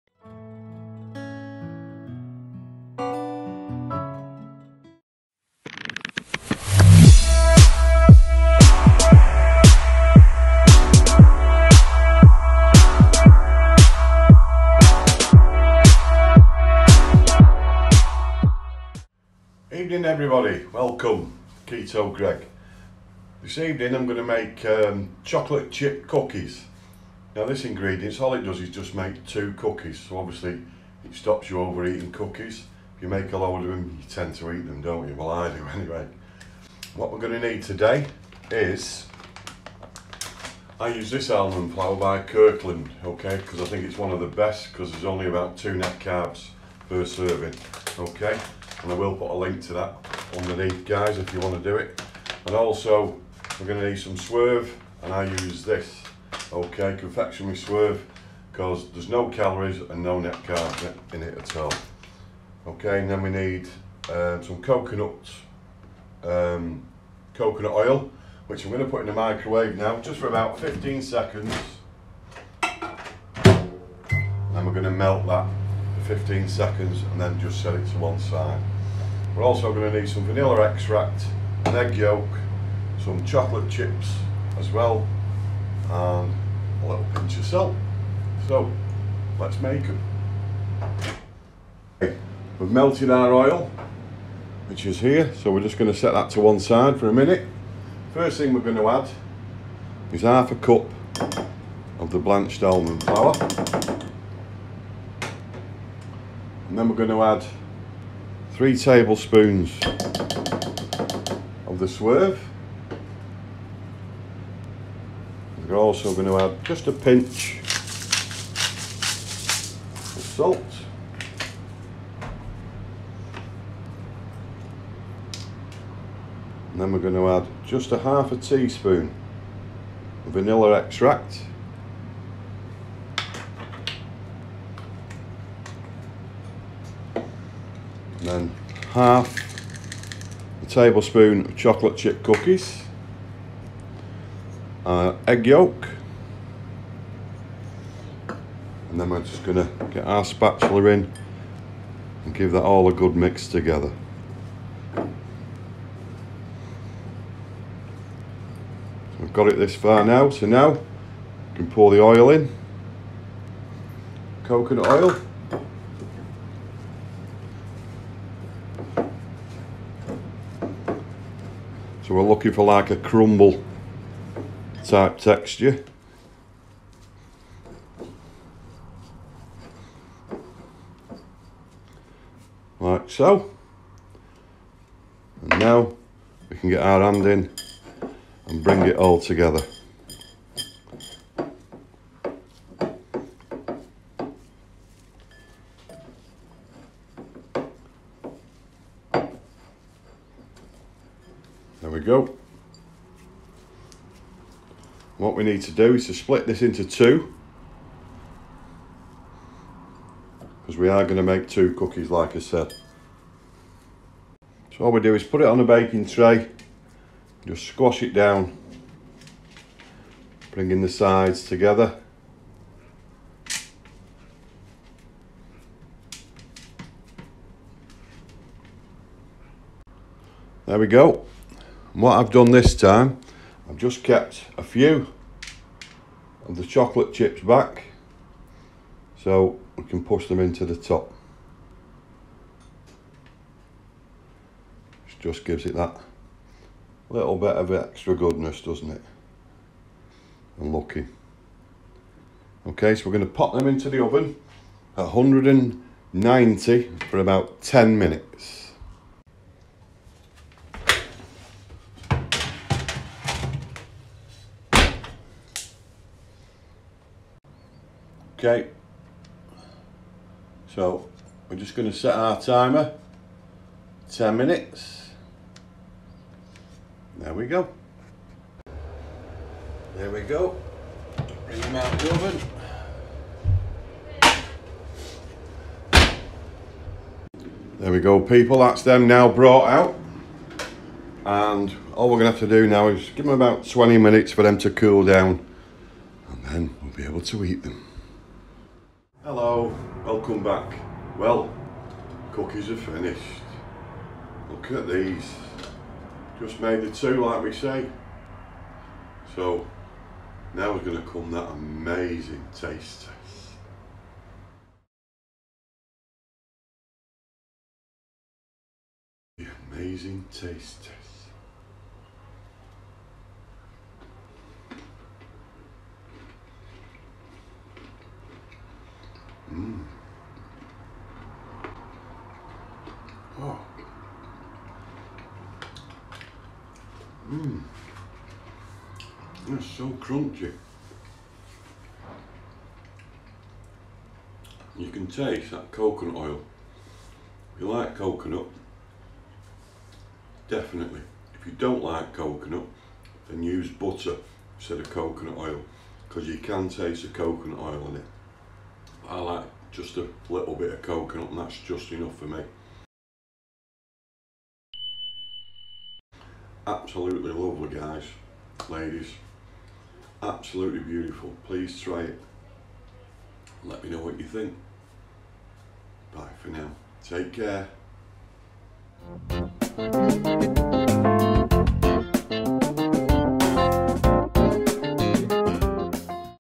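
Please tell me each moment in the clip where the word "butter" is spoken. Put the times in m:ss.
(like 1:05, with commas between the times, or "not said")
5:53.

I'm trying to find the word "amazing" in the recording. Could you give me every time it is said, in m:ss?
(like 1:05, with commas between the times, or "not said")
5:11, 5:19.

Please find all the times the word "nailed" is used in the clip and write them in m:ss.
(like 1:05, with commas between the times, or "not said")
not said.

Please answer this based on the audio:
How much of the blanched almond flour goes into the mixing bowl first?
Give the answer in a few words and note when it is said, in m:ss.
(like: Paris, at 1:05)
half a cup, at 1:40.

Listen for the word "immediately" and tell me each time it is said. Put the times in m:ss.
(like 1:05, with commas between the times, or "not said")
not said.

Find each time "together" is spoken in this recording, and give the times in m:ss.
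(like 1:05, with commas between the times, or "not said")
2:33, 3:09, 3:41.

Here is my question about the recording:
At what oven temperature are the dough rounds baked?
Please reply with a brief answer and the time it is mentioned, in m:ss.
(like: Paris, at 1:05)
190, at 4:15.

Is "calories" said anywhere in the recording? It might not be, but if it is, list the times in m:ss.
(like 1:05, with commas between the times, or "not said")
0:59.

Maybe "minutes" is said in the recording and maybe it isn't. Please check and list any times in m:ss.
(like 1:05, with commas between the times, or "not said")
1:37, 4:17, 4:34, 4:53.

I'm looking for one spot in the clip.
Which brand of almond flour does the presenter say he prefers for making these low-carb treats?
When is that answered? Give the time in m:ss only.
0:42.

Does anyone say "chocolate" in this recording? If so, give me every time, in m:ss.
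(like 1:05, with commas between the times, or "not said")
0:25, 1:23, 2:21, 3:56.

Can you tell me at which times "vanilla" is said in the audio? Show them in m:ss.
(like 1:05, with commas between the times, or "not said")
1:20, 2:10.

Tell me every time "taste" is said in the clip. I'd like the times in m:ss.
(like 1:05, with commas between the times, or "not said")
5:12, 5:20, 5:45, 5:56.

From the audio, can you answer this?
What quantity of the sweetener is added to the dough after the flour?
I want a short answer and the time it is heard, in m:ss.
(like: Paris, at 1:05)
3 tablespoons, at 1:48.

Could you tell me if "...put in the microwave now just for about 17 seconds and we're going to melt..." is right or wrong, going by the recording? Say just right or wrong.
wrong.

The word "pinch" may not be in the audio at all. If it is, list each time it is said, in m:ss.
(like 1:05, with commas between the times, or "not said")
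1:27, 1:56.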